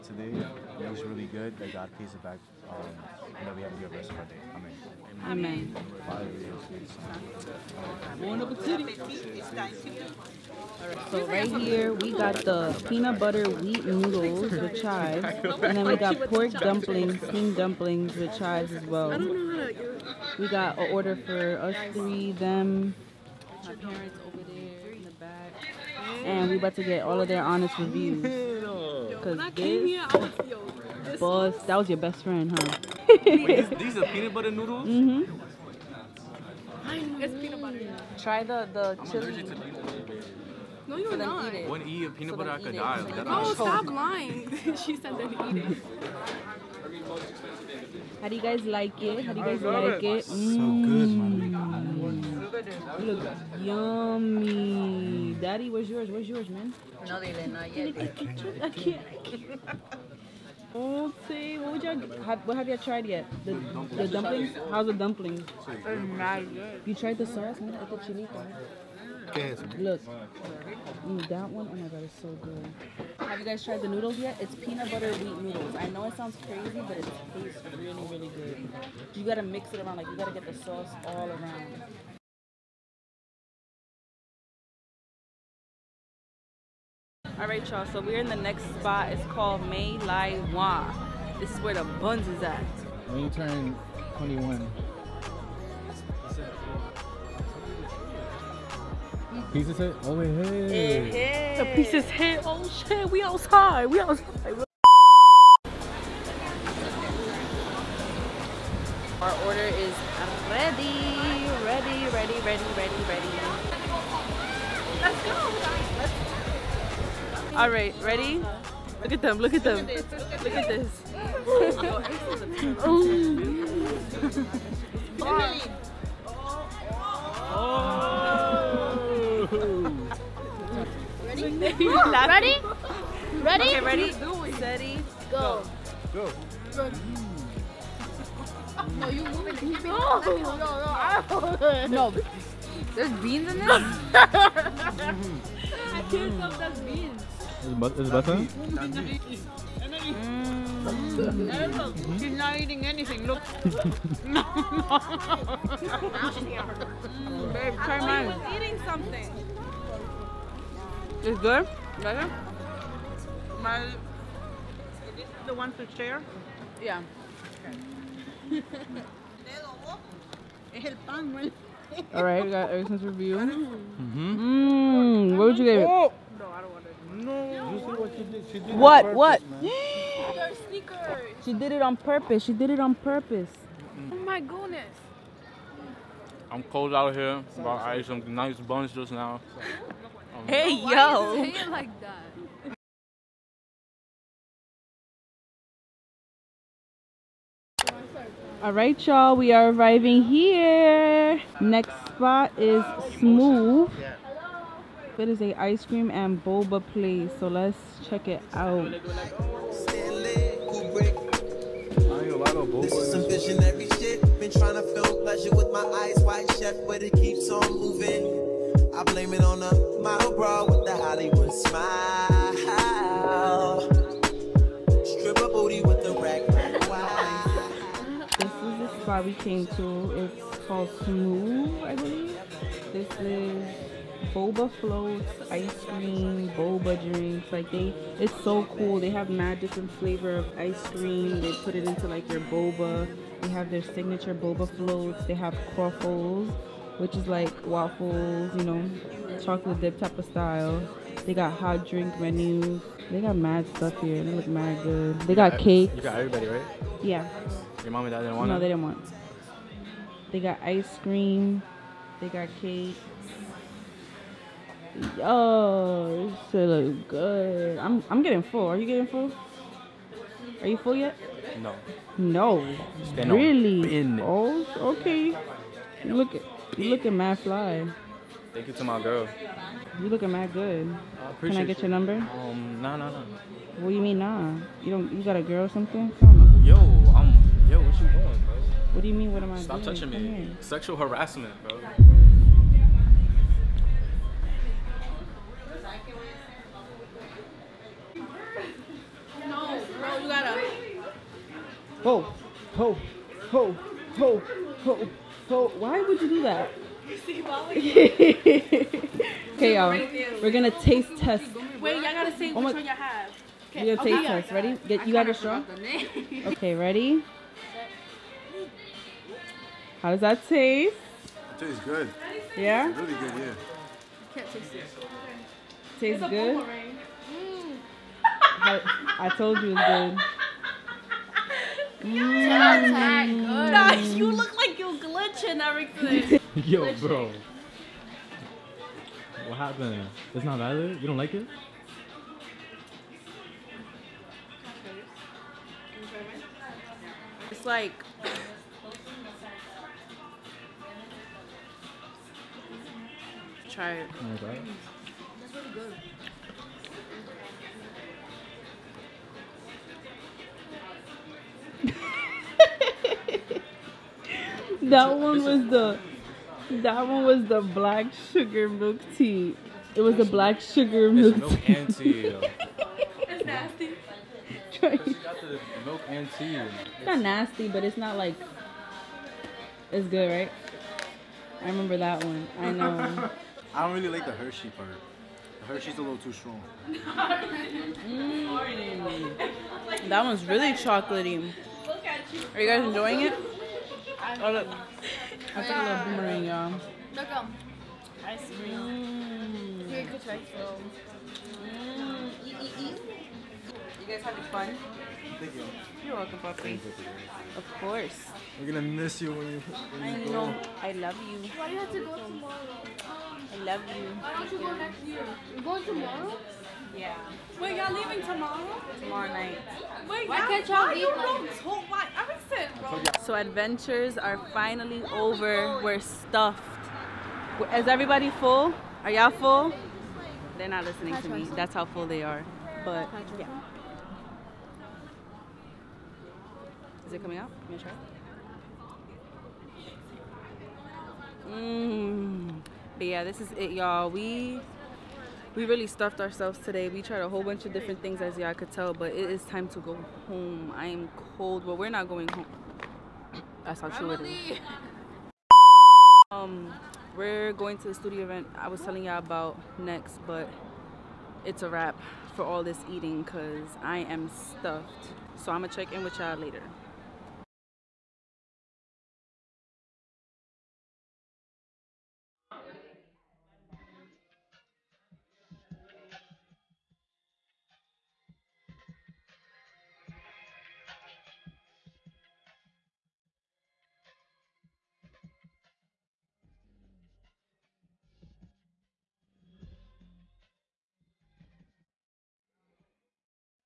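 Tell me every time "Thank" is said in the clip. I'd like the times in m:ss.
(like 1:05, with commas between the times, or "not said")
4:38, 6:45.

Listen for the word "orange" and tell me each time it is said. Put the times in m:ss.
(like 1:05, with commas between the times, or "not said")
not said.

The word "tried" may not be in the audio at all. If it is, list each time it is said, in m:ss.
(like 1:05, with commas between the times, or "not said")
1:02, 1:06, 1:13, 7:27.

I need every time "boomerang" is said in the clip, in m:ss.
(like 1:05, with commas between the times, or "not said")
6:36.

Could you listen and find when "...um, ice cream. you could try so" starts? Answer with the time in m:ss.
6:37.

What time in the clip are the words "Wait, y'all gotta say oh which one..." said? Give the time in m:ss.
5:11.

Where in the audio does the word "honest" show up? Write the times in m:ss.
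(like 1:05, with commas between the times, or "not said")
0:27.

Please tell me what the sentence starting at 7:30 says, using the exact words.
I am cold, but we're not going home.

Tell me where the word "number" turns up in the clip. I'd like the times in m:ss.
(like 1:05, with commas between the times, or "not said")
4:41.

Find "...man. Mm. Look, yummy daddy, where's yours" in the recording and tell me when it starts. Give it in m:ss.
0:51.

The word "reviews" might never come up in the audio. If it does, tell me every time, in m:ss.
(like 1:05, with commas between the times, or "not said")
0:27, 2:53.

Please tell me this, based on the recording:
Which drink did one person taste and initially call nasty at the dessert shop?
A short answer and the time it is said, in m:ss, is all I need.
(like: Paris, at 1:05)
black sugar milk tea, at 6:07.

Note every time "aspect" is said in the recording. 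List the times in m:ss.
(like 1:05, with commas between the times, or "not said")
not said.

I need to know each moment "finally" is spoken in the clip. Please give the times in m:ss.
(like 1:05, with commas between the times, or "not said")
7:04.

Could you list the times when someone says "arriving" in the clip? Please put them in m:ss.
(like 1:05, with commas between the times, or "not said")
3:19.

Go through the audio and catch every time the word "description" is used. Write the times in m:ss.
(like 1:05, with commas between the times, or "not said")
not said.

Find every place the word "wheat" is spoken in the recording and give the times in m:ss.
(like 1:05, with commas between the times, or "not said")
0:13, 1:15.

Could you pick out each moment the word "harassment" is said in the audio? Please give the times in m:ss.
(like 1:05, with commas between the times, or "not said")
4:50.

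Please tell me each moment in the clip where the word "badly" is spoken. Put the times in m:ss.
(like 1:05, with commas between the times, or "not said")
not said.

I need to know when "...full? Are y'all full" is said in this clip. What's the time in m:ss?
7:08.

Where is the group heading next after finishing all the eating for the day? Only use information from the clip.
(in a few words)
studio event.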